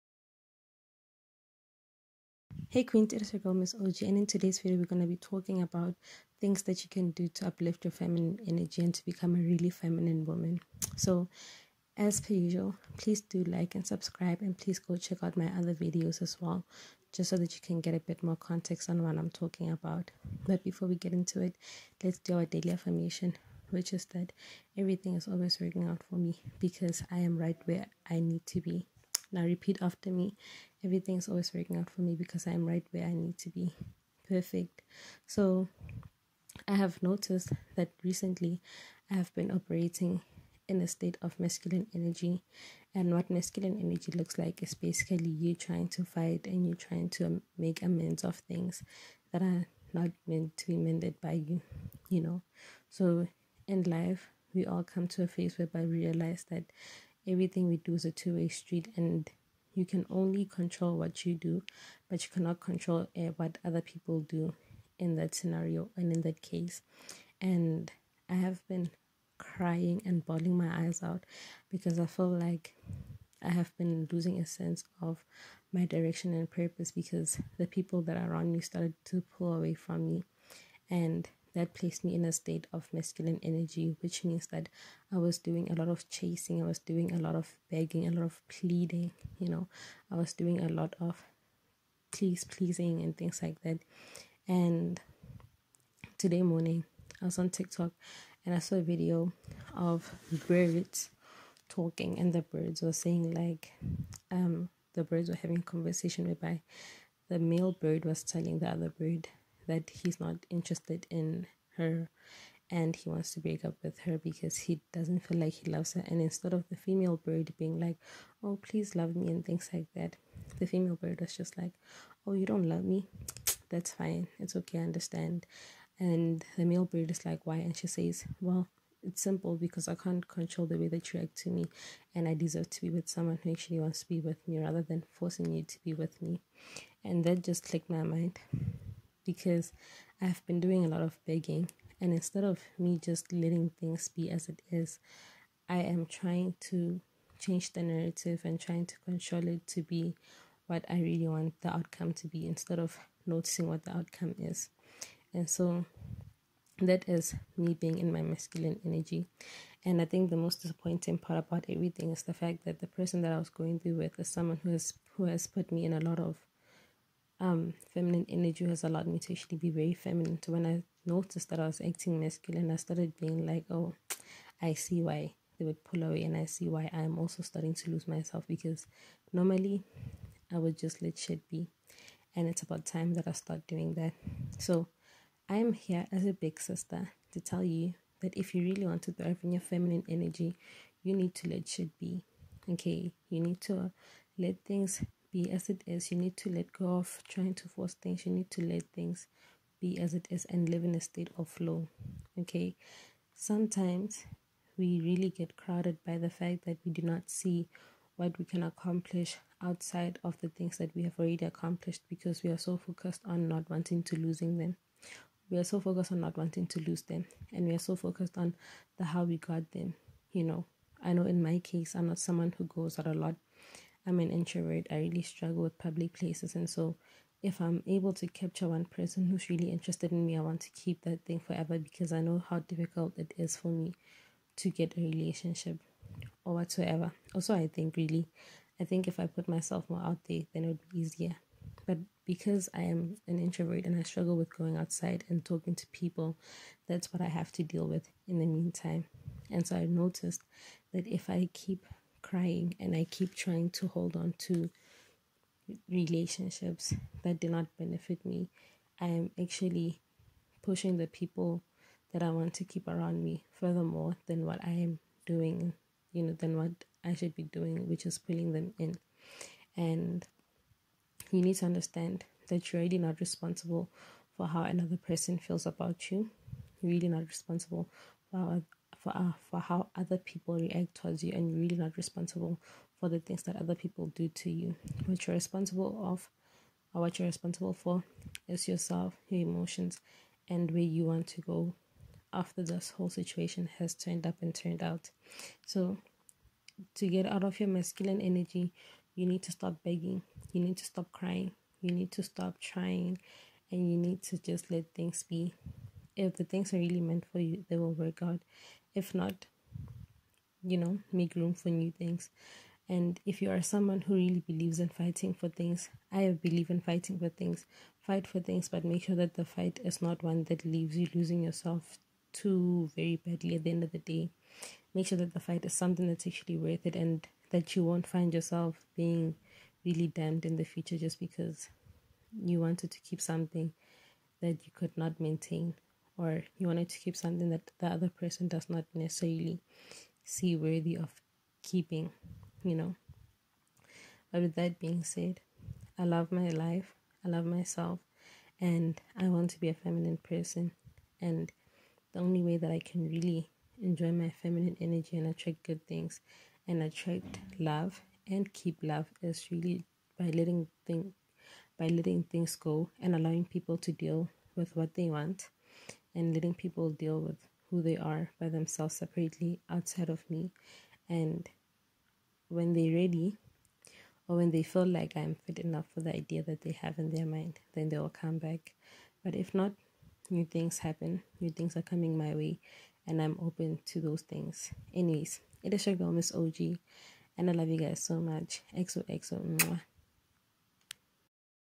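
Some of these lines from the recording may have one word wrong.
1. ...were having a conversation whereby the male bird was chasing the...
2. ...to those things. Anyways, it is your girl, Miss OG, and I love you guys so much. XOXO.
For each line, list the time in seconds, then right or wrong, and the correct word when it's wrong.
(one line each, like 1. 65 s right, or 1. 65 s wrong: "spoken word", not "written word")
1. 105 s wrong: "telling", not "chasing"
2. 383 s right.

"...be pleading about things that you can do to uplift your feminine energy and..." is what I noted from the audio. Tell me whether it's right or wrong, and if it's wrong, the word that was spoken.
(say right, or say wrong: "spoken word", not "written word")
wrong: "talking", not "pleading".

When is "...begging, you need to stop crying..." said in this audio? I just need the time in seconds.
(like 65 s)
299 s.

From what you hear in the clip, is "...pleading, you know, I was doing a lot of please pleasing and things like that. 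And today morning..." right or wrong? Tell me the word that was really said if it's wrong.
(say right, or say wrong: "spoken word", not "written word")
right.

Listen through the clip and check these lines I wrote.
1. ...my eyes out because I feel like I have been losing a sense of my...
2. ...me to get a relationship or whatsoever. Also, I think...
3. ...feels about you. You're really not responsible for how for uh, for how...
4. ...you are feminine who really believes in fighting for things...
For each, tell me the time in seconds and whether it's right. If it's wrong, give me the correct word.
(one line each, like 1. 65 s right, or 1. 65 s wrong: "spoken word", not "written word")
1. 70 s right
2. 233 s right
3. 275 s right
4. 313 s wrong: "someone", not "feminine".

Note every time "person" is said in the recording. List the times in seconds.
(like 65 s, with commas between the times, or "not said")
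162 s, 228 s, 274 s, 338 s, 350 s.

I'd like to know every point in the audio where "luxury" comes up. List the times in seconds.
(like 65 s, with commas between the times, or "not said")
not said.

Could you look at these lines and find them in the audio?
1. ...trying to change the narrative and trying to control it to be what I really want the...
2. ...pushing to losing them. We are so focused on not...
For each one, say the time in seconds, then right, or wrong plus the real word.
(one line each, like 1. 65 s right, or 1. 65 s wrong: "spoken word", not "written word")
1. 146 s right
2. 213 s wrong: "wanting", not "pushing".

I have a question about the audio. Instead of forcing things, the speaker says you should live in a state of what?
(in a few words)
Flow.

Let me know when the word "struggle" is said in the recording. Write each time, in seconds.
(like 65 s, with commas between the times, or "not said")
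225 s, 244 s.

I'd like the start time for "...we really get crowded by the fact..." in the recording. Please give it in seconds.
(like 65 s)
204 s.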